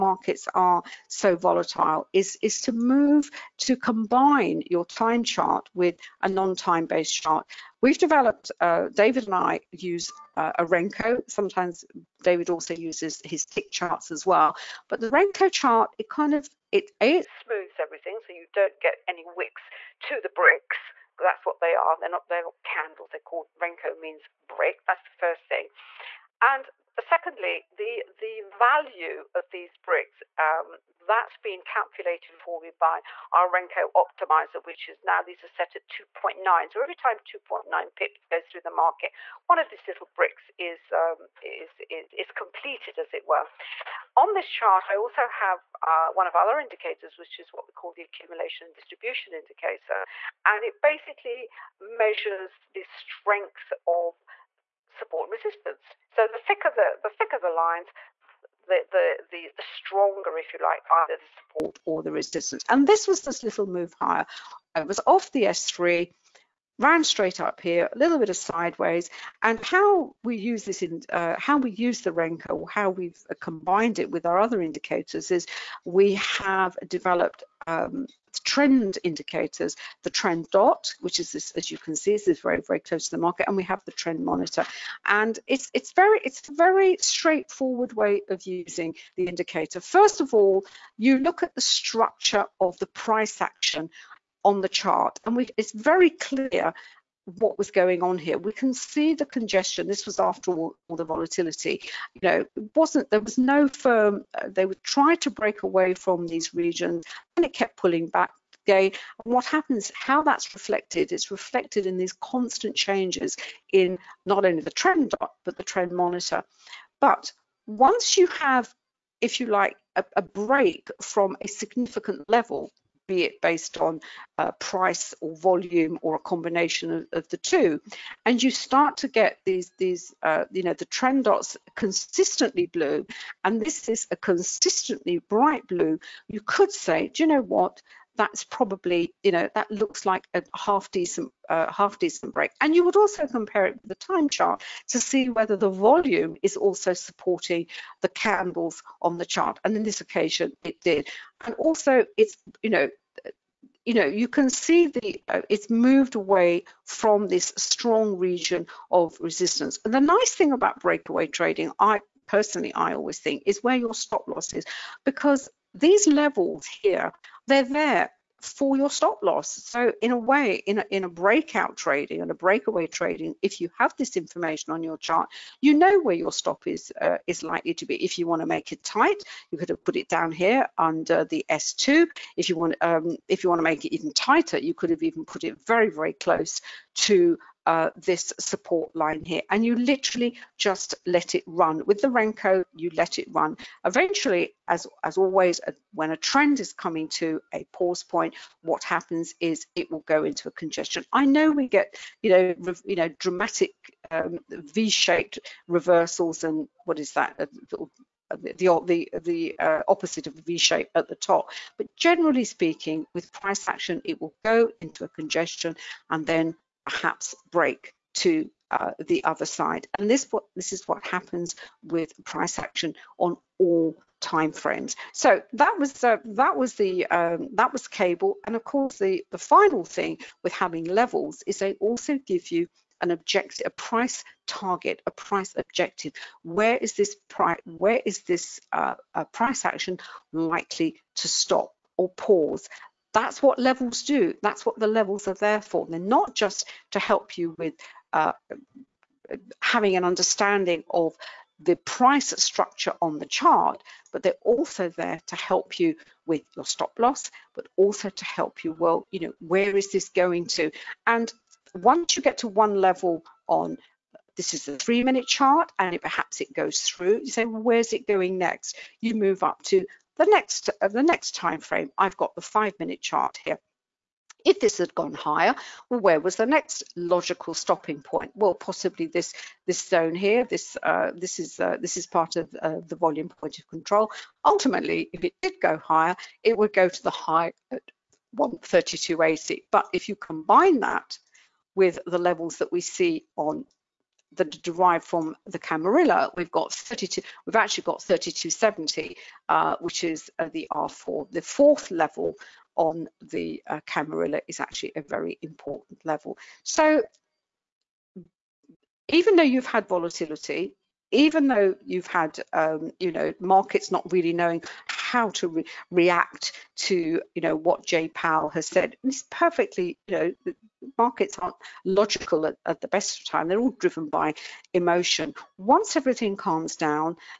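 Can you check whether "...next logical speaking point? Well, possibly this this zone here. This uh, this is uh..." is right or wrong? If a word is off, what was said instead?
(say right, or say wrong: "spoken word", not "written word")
wrong: "stopping", not "speaking".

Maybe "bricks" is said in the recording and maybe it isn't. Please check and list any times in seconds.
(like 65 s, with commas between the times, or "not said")
20 s, 24 s, 29 s, 40 s.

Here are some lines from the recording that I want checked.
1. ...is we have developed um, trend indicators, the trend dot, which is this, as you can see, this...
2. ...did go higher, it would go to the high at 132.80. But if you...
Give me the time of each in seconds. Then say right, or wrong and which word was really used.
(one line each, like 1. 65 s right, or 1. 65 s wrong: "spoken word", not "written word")
1. 75 s right
2. 285 s right.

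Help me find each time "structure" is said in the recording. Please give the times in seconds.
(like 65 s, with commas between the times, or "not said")
91 s, 252 s.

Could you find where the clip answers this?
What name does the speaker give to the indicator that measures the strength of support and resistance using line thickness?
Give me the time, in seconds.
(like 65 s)
48 s.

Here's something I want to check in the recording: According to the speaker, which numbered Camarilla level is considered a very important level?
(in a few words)
R4.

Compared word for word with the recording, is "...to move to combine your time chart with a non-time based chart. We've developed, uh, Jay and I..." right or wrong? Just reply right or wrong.
wrong.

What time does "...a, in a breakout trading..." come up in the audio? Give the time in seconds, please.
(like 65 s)
170 s.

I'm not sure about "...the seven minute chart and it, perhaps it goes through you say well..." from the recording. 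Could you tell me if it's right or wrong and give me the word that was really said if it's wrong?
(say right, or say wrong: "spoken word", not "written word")
wrong: "three", not "seven".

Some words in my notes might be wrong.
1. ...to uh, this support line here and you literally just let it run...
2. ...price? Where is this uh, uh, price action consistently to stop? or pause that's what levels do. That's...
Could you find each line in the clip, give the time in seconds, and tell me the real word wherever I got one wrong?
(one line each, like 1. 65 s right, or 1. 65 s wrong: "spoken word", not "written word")
1. 186 s right
2. 237 s wrong: "likely", not "consistently".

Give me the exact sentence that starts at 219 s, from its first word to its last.
And this, what, this is what happens with price action on all timeframes.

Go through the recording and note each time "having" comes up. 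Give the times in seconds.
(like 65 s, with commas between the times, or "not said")
230 s, 249 s.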